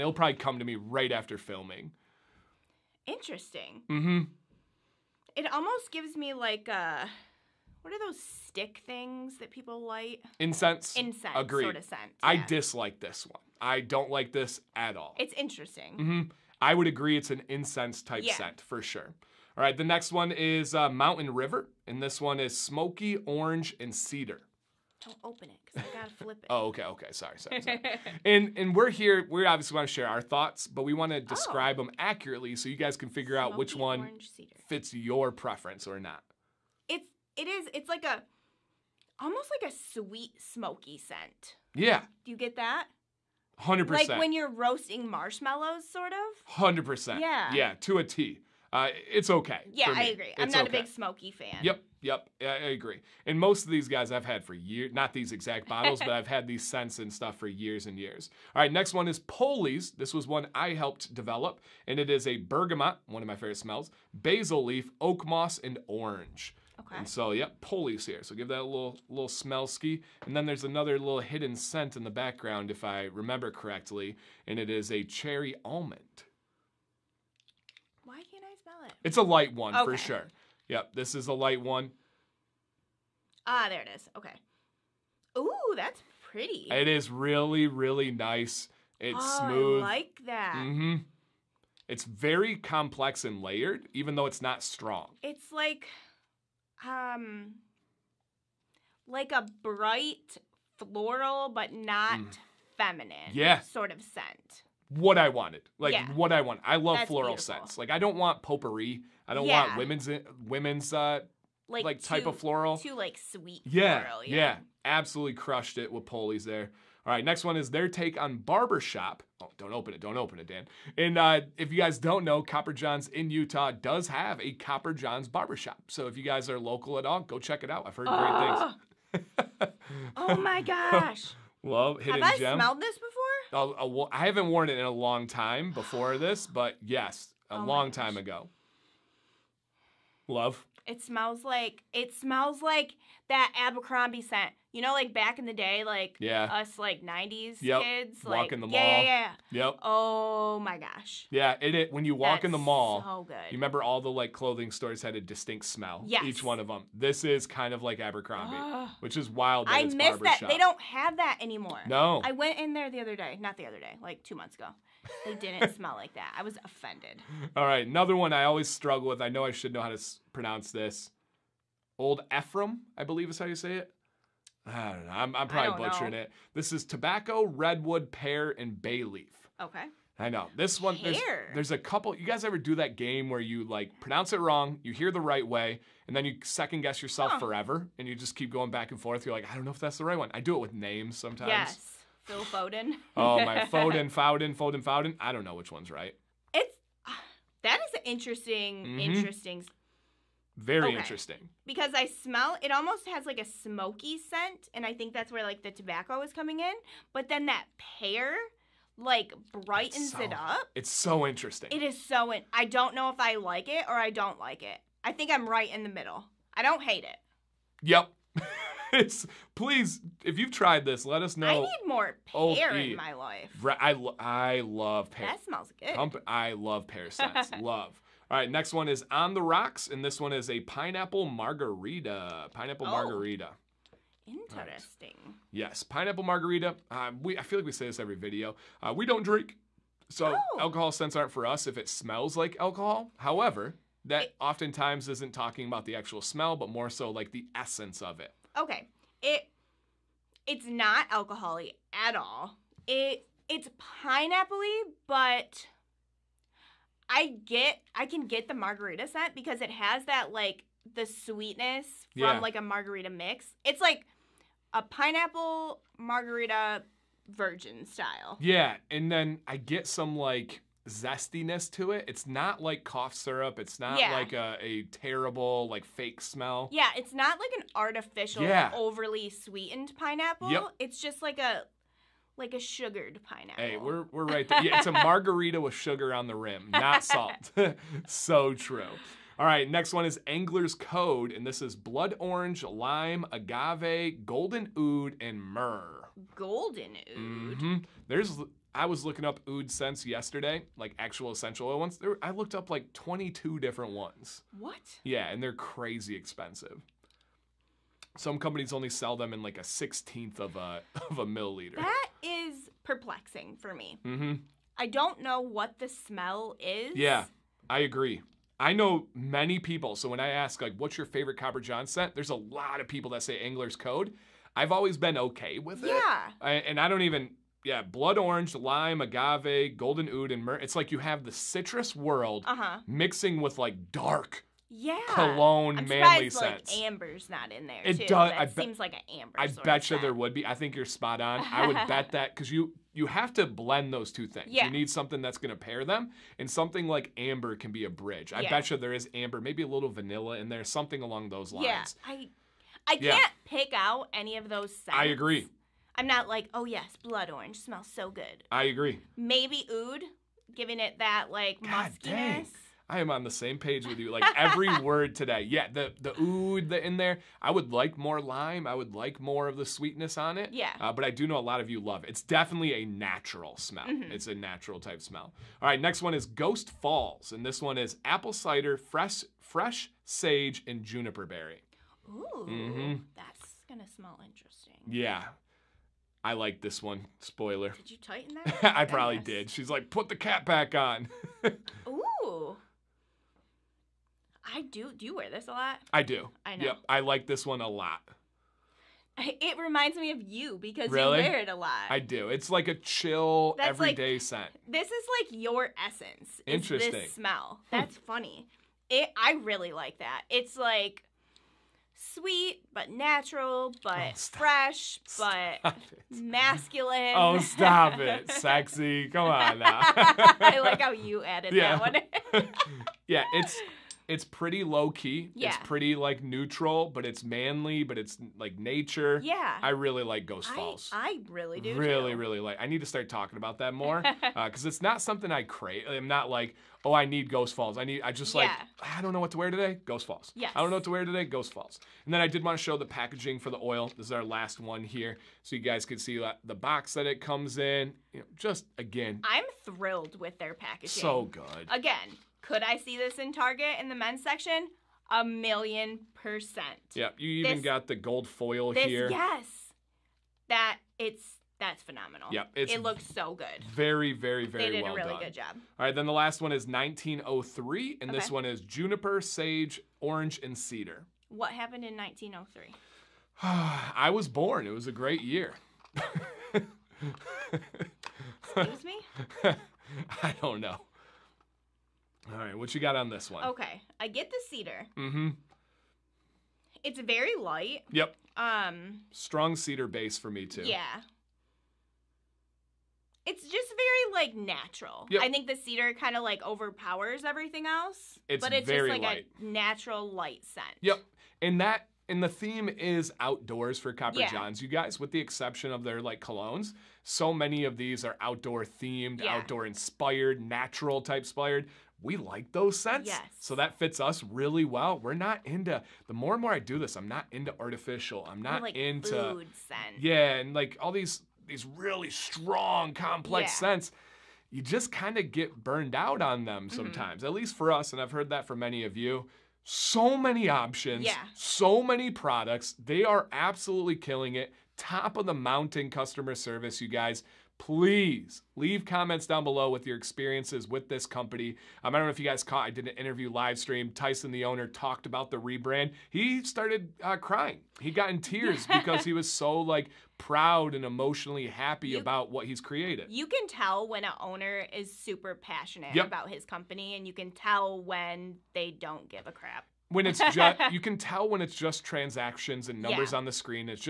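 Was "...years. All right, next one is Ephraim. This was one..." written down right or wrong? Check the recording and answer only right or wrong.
wrong.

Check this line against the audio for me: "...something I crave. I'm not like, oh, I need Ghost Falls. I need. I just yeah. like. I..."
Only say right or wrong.
right.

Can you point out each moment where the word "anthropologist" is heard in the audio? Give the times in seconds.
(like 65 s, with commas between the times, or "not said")
not said.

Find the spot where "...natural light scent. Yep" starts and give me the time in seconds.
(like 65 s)
499 s.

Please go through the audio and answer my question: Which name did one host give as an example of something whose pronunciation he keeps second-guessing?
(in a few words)
Phil Foden.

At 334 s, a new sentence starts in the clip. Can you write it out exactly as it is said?
Yeah, cologne I'm manly surprised, Like, amber's not in there.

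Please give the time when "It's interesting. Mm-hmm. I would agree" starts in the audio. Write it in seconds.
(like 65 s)
15 s.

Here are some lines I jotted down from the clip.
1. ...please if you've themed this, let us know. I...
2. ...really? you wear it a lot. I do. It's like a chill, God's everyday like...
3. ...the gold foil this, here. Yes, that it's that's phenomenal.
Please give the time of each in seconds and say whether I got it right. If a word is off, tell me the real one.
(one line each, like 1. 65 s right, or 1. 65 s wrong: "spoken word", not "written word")
1. 219 s wrong: "tried", not "themed"
2. 400 s wrong: "That", not "God"
3. 457 s right.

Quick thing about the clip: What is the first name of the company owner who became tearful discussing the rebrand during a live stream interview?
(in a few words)
Tyson.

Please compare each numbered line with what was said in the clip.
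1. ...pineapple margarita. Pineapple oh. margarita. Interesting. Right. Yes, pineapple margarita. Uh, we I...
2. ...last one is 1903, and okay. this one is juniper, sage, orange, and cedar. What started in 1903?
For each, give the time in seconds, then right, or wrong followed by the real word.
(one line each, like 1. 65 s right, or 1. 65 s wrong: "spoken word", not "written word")
1. 230 s right
2. 466 s wrong: "happened", not "started".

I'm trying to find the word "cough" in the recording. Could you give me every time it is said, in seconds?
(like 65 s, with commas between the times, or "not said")
272 s.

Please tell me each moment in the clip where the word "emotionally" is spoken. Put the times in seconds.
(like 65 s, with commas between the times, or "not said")
550 s.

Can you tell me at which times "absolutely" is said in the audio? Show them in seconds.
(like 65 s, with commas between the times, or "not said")
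114 s, 533 s.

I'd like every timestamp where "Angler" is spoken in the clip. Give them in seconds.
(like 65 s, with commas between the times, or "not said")
290 s, 323 s.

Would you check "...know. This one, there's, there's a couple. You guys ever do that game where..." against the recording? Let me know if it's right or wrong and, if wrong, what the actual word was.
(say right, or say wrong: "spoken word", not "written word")
right.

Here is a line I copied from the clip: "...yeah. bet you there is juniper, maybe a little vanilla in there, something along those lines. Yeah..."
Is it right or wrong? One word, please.
wrong.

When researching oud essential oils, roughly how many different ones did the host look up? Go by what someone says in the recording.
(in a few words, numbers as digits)
22.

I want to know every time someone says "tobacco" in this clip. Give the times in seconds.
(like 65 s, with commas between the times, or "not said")
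176 s, 205 s.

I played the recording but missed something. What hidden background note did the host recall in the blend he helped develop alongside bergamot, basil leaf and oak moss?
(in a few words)
cherry almond.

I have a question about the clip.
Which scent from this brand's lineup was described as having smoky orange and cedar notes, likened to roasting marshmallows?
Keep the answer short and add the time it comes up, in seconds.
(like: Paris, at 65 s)
Mountain River, at 20 s.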